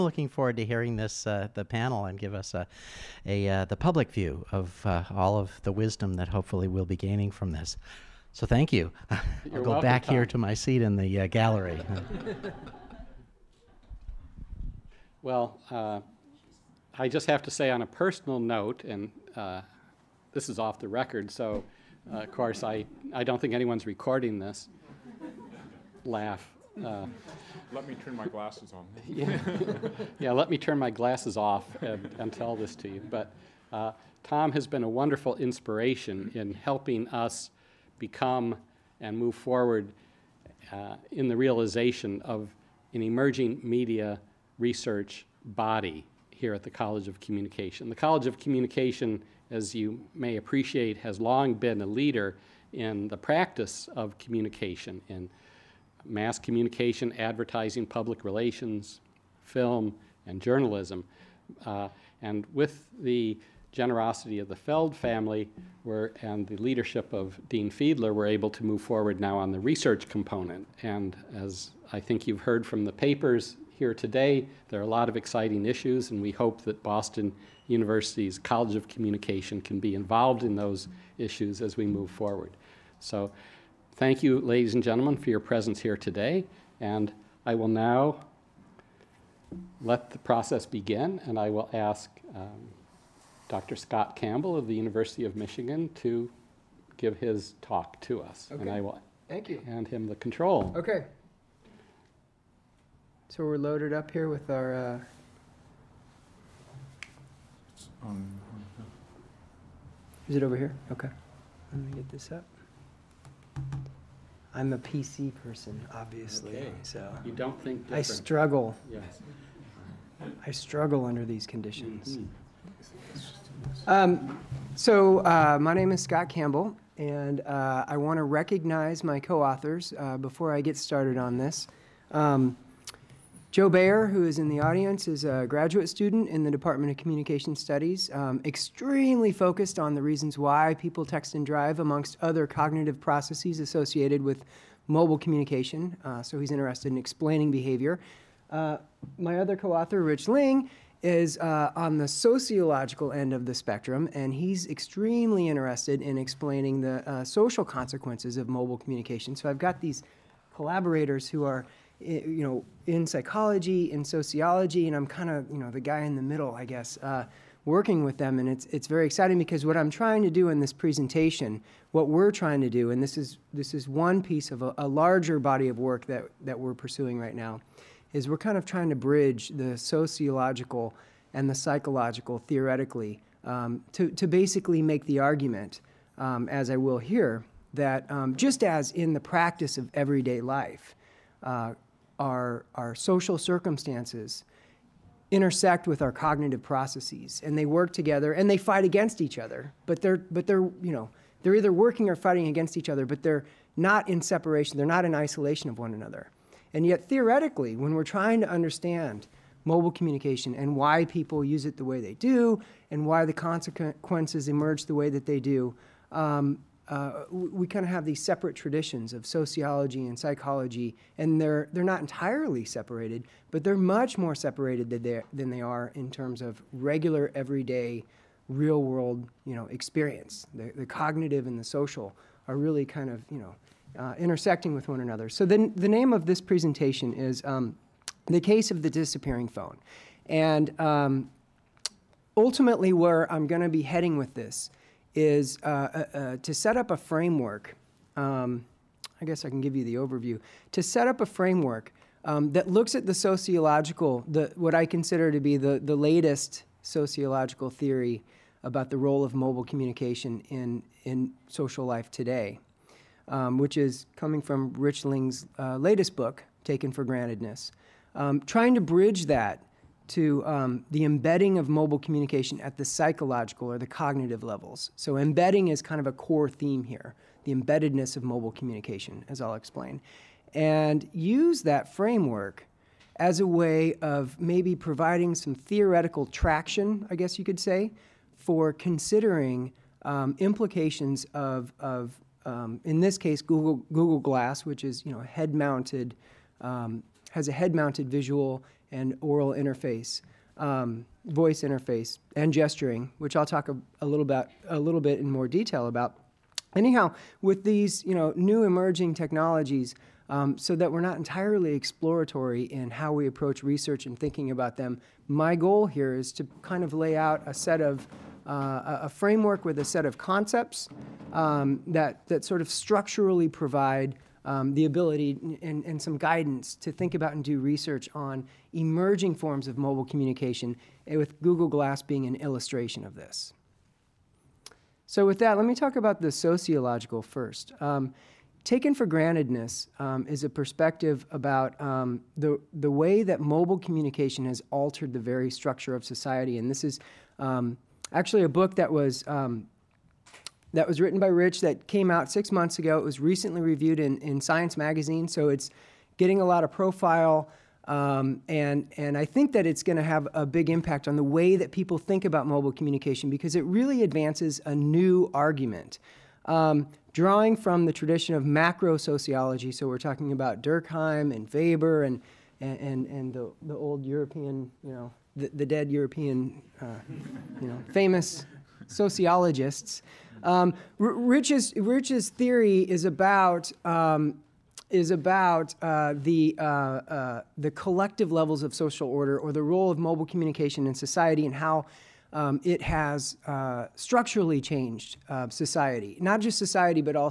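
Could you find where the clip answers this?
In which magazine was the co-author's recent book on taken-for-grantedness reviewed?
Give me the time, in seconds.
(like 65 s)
354 s.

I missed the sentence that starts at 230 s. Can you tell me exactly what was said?
The, the cognitive and the social are really kind of you know, uh, intersecting with one another.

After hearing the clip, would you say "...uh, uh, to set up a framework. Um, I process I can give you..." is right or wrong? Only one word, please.
wrong.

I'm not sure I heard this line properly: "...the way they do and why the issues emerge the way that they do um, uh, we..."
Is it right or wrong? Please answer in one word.
wrong.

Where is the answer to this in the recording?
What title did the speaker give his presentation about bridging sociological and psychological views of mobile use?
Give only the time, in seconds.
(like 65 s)
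238 s.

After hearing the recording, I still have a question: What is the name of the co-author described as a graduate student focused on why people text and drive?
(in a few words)
Joe Bayer.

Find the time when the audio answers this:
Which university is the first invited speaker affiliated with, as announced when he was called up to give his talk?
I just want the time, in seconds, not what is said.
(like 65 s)
94 s.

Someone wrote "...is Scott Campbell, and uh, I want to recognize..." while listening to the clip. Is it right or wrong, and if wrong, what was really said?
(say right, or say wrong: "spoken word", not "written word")
right.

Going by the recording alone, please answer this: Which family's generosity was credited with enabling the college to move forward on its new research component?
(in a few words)
Feld family.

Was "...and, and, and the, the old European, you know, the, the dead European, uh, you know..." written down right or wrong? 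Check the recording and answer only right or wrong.
right.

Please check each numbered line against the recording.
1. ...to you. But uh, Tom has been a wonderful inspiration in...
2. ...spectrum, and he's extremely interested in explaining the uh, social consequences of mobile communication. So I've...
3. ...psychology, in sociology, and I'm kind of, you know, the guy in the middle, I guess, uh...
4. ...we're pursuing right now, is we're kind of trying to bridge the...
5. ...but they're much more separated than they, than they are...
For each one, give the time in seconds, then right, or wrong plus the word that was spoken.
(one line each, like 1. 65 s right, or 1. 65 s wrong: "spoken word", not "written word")
1. 32 s right
2. 153 s right
3. 163 s right
4. 176 s right
5. 223 s right.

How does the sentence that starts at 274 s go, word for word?
So, embedding is kind of a core theme here the embeddedness of mobile communication, as I'll explain.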